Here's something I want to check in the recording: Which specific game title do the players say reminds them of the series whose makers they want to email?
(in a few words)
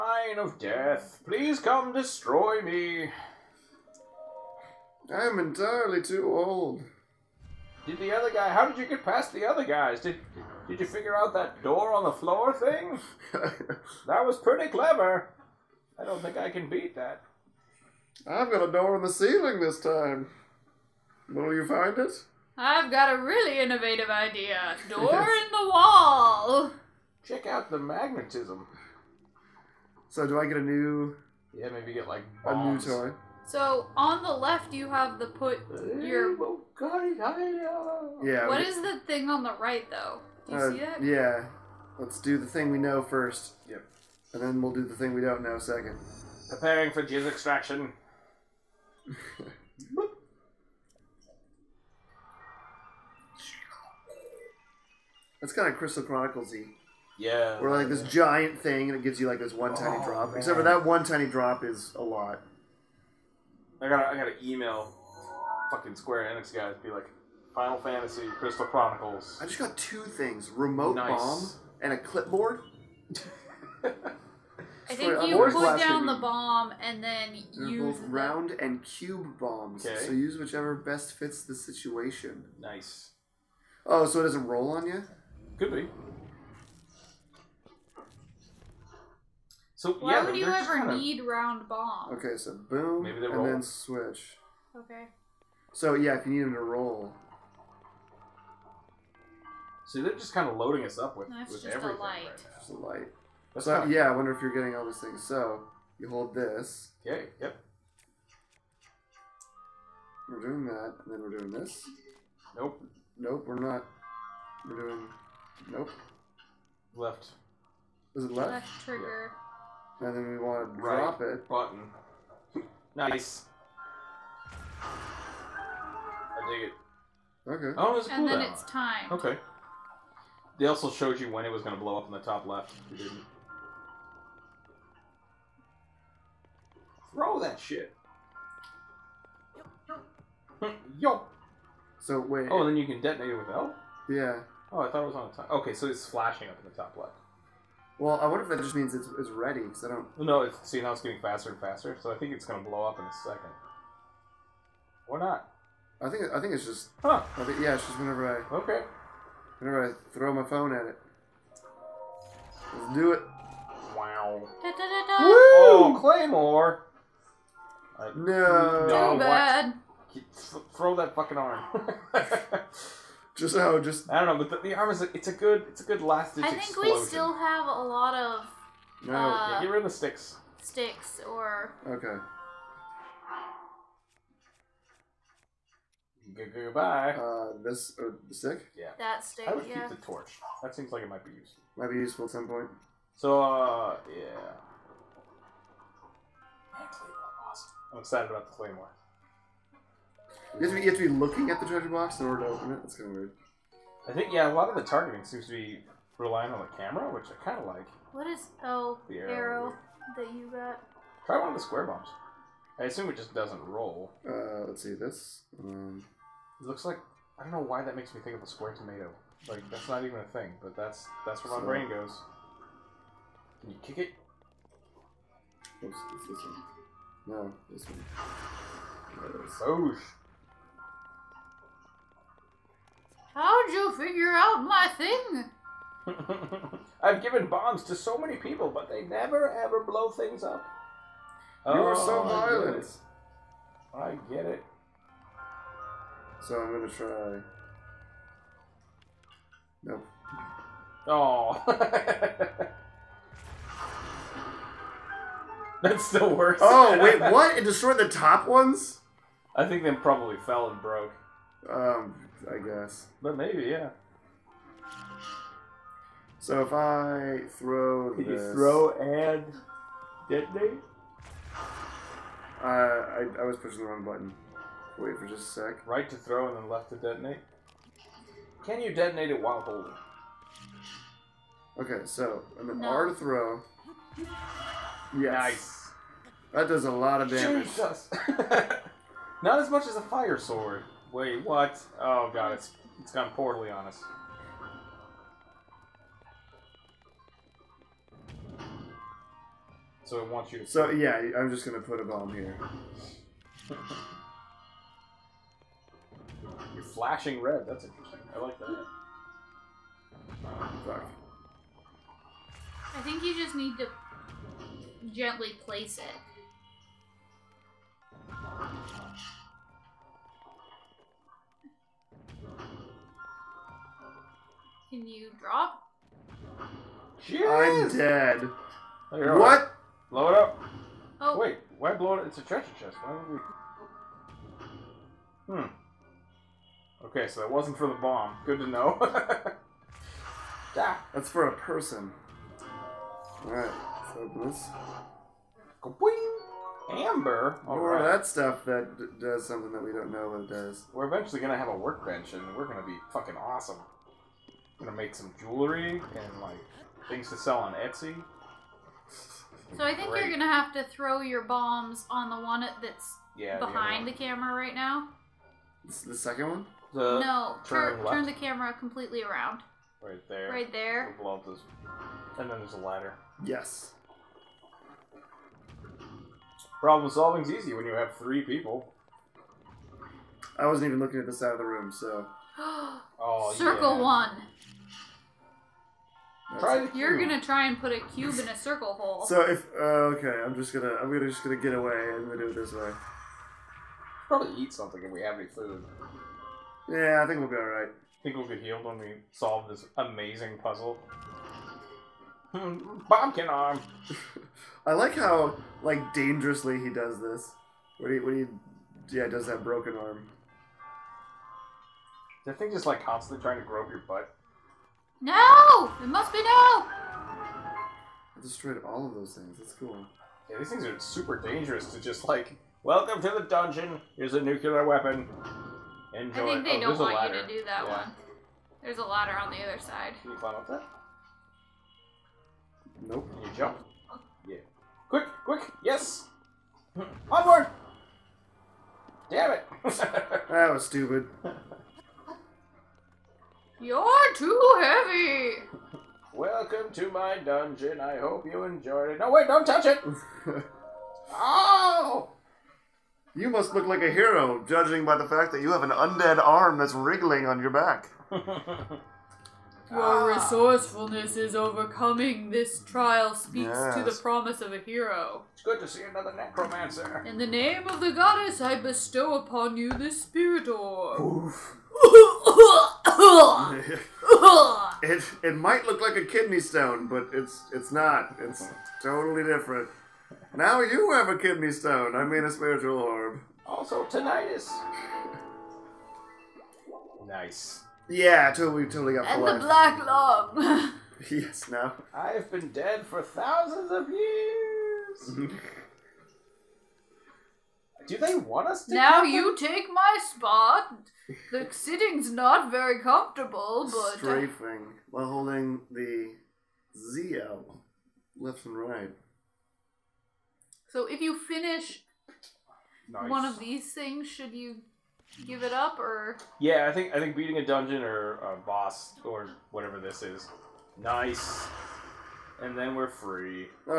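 Final Fantasy Crystal Chronicles.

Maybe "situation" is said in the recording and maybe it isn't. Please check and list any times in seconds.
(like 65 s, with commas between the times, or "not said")
81 s.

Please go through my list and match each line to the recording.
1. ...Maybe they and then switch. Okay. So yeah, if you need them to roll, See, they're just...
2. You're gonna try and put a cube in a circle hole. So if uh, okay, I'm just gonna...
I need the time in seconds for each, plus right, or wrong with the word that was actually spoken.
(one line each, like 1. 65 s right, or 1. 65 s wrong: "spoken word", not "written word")
1. 93 s right
2. 386 s right.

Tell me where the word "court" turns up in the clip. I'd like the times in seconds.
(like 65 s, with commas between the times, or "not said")
not said.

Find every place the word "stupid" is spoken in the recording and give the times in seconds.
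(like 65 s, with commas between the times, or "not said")
440 s.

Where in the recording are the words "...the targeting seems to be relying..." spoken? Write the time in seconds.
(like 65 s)
204 s.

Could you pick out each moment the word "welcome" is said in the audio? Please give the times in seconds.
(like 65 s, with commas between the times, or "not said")
422 s, 446 s.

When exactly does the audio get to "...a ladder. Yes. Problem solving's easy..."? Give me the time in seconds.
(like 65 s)
372 s.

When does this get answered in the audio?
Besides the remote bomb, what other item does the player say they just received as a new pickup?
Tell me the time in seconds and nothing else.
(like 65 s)
71 s.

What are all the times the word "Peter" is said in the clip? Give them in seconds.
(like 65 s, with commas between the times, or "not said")
not said.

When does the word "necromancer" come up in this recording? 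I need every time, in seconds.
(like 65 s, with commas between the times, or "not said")
466 s.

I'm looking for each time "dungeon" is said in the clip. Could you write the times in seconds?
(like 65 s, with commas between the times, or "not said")
423 s, 447 s, 517 s.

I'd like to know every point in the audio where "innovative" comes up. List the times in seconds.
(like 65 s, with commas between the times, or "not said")
23 s.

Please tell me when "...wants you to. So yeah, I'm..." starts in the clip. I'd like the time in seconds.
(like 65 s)
300 s.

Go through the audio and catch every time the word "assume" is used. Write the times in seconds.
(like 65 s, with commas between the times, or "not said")
212 s.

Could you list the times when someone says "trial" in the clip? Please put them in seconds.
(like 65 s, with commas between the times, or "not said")
462 s.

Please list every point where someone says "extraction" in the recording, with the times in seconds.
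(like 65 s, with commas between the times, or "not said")
47 s.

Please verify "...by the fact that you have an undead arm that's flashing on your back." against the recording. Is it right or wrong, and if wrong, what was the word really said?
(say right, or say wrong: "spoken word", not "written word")
wrong: "wriggling", not "flashing".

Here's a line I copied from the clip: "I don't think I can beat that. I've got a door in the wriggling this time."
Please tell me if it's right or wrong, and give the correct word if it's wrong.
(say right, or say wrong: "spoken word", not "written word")
wrong: "ceiling", not "wriggling".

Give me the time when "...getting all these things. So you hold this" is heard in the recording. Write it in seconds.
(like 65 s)
104 s.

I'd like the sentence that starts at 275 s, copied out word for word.
Right to throw and then left to detonate?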